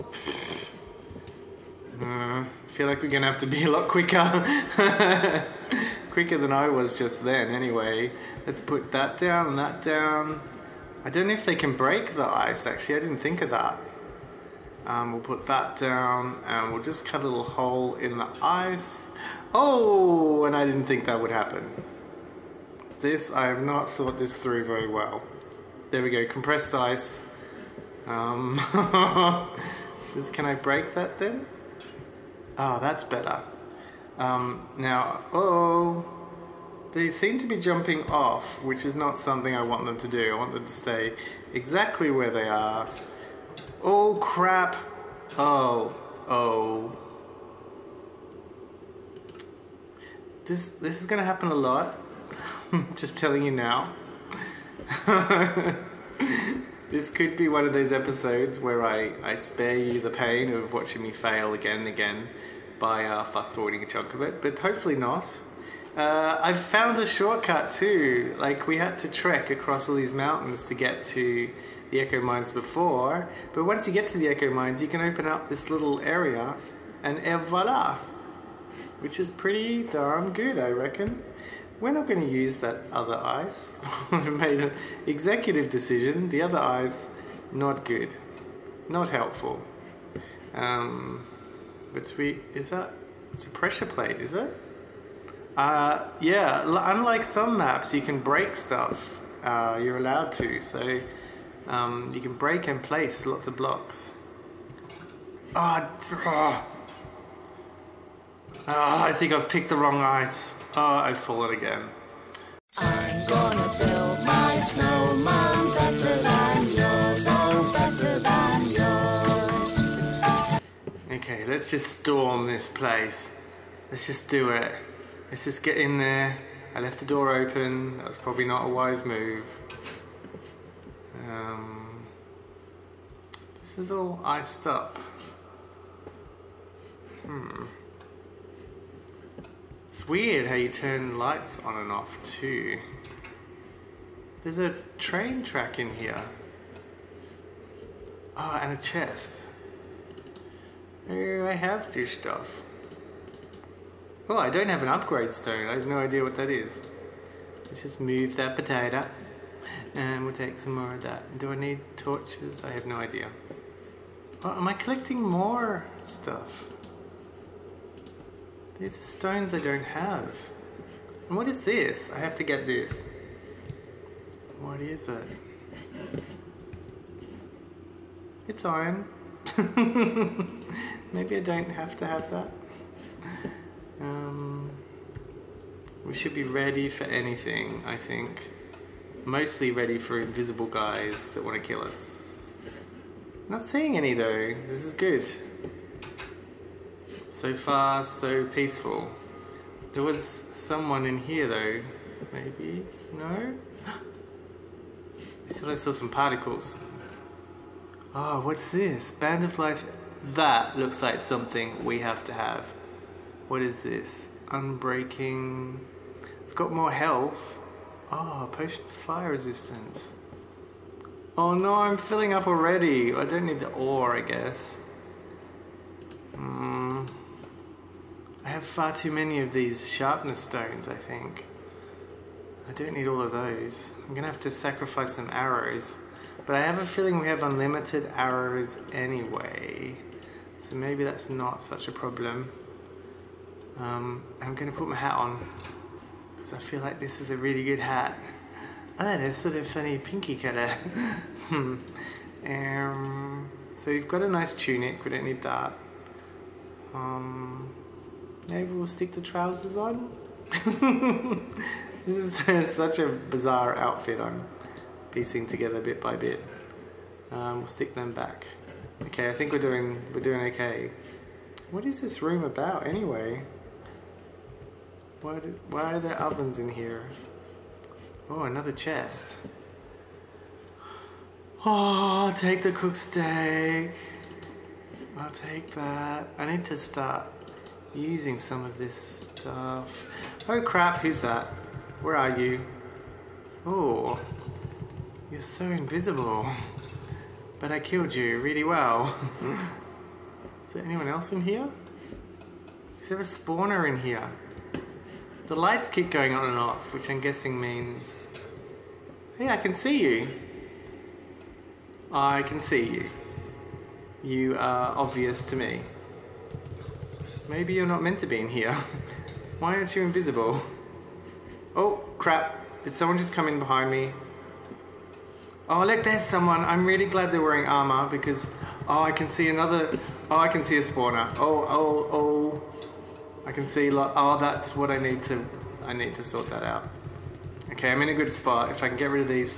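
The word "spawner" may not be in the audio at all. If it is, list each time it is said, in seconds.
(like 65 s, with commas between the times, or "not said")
303 s, 330 s.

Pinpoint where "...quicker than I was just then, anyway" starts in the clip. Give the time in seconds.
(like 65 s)
6 s.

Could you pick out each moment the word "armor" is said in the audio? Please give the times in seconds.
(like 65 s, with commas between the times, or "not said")
327 s.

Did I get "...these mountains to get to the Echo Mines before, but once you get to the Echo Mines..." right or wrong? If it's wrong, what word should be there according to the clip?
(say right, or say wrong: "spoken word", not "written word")
right.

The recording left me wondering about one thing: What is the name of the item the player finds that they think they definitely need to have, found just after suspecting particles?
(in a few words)
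Band of Life.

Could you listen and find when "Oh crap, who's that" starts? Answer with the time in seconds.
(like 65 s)
290 s.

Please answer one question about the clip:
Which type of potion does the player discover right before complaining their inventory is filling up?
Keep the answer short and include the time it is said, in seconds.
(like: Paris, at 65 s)
fire resistance, at 218 s.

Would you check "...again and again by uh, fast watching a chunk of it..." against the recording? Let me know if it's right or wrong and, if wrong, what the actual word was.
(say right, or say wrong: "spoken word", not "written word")
wrong: "forwarding", not "watching".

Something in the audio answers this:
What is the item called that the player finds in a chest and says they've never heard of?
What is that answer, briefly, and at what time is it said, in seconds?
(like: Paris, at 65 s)
upgrade stone, at 154 s.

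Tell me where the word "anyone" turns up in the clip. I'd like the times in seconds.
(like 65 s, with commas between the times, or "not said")
300 s.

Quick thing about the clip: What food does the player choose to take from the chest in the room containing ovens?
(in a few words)
cooked steak.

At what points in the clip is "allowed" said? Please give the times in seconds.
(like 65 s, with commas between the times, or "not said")
99 s.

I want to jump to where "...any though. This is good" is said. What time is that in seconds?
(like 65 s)
193 s.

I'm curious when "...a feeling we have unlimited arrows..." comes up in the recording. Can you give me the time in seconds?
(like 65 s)
236 s.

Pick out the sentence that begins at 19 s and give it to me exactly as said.
Oh, and I didn't think that would happen.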